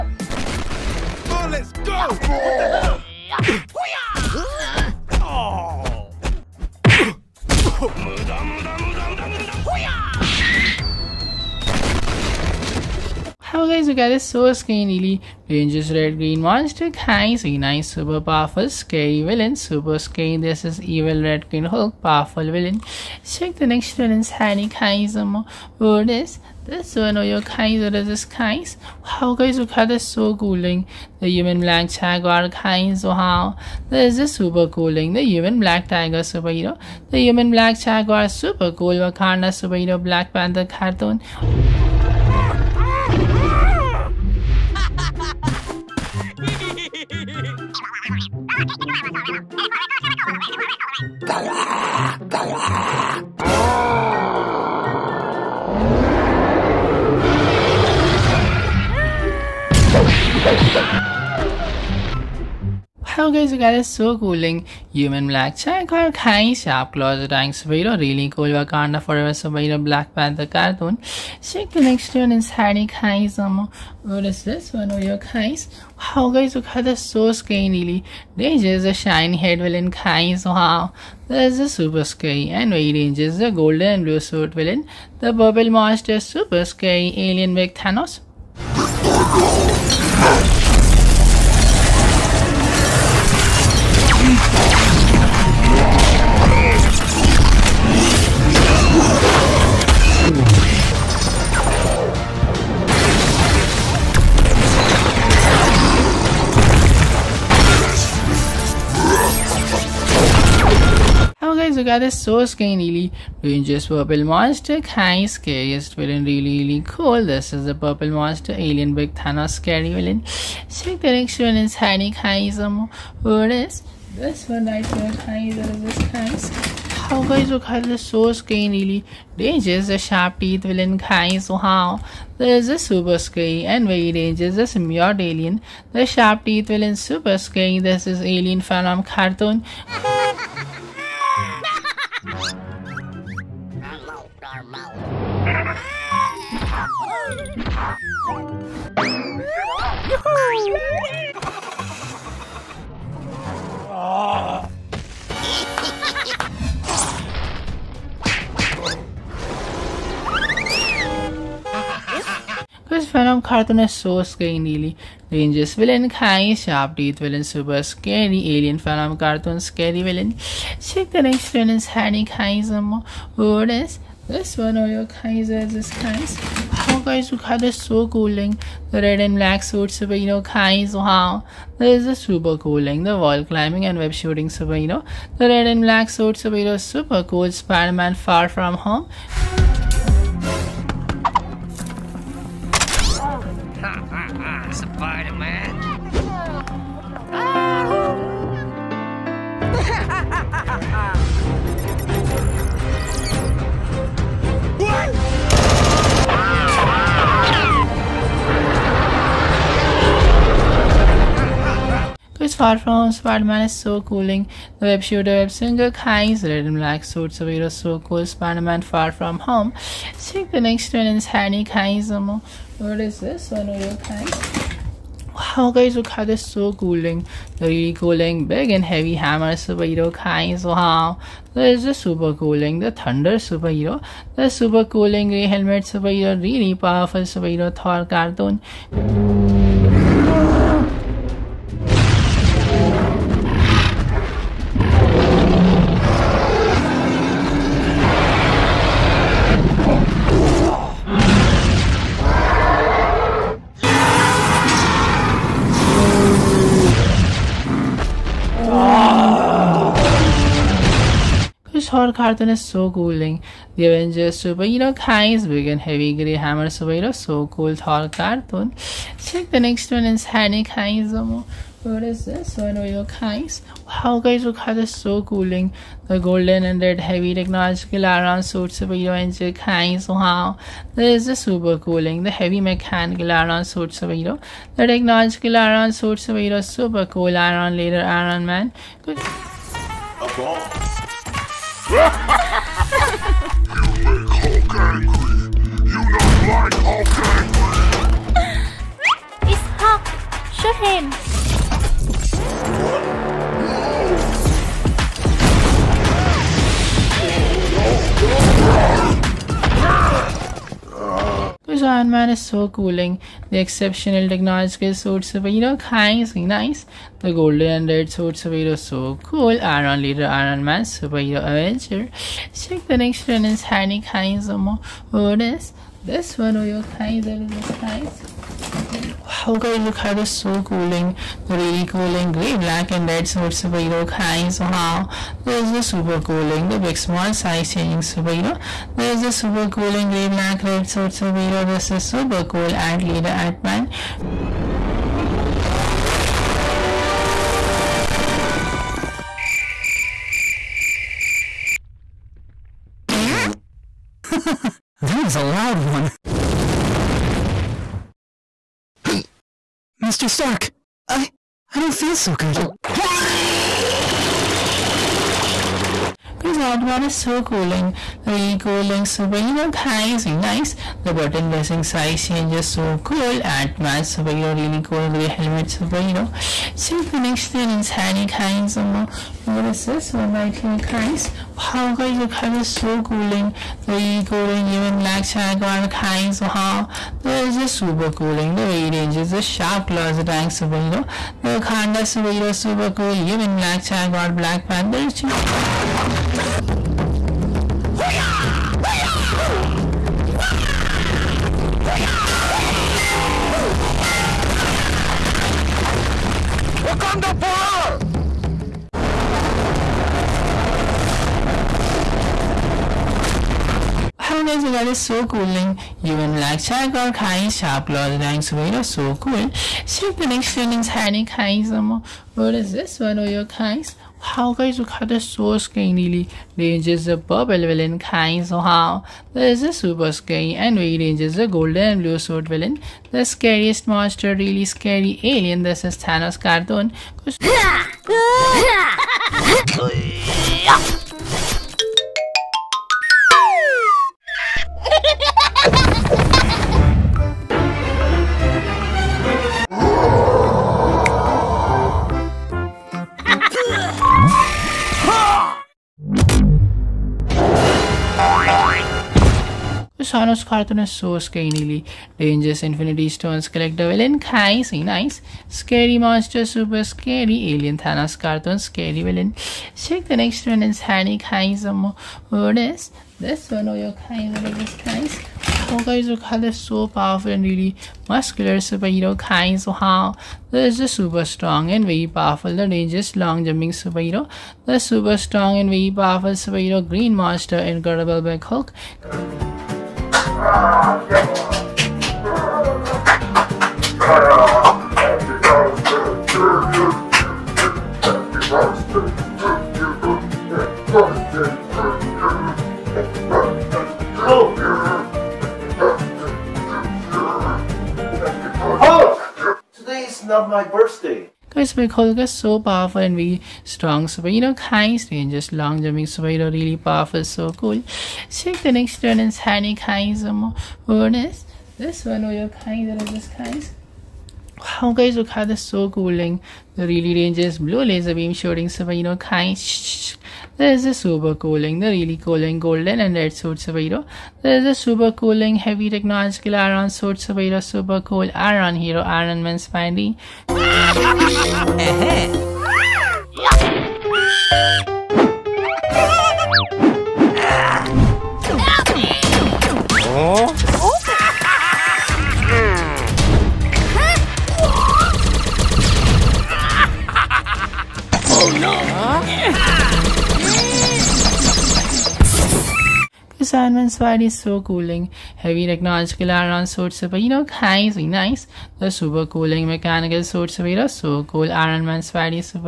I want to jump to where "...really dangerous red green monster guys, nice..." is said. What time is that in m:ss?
0:14.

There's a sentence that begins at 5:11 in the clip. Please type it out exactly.
Because Iron Man is so cooling.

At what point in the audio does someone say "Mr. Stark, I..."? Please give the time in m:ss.
6:00.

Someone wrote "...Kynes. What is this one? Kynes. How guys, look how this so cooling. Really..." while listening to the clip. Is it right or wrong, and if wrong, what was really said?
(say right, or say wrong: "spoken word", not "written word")
right.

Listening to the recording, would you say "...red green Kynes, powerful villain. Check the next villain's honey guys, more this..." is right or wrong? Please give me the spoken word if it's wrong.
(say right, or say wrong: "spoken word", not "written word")
wrong: "Hulk", not "Kynes".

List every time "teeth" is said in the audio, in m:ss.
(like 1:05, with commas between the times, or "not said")
2:10, 2:16, 2:46.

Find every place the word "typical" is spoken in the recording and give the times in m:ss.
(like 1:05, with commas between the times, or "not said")
not said.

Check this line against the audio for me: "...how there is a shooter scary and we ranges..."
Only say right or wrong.
wrong.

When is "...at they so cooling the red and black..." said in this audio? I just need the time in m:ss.
2:57.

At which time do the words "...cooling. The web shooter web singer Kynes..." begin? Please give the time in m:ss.
3:34.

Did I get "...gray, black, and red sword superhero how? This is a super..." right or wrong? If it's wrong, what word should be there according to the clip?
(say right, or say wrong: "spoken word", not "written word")
right.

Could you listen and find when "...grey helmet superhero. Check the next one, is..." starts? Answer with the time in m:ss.
6:15.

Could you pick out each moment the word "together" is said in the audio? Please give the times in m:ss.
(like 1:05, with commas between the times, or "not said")
1:51, 6:54.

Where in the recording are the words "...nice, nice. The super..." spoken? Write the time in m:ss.
9:27.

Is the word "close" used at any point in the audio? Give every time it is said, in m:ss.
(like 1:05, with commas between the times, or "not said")
6:57.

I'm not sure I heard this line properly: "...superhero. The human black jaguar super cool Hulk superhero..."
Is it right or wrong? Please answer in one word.
wrong.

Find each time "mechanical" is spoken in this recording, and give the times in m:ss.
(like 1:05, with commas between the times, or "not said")
4:42, 9:29.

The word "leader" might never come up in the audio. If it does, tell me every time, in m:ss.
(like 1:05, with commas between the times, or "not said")
4:47, 5:20, 5:43.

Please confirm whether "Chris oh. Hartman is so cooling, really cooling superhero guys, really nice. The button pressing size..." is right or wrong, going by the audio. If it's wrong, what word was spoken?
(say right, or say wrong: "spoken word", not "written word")
right.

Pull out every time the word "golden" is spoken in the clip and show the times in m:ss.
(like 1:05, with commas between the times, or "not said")
1:23, 4:36, 5:17, 7:11, 8:52.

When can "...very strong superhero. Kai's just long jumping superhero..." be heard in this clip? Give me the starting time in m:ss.
8:33.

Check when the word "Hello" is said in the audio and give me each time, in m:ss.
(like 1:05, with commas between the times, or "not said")
0:13.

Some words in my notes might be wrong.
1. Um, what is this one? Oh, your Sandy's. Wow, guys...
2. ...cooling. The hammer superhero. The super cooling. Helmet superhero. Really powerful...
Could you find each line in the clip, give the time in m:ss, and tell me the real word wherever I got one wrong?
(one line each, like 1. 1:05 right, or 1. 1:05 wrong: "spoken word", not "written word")
1. 1:13 wrong: "Kai", not "Sandy"
2. 3:52 wrong: "thunder", not "hammer".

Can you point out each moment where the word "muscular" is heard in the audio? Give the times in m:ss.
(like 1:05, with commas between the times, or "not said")
7:58.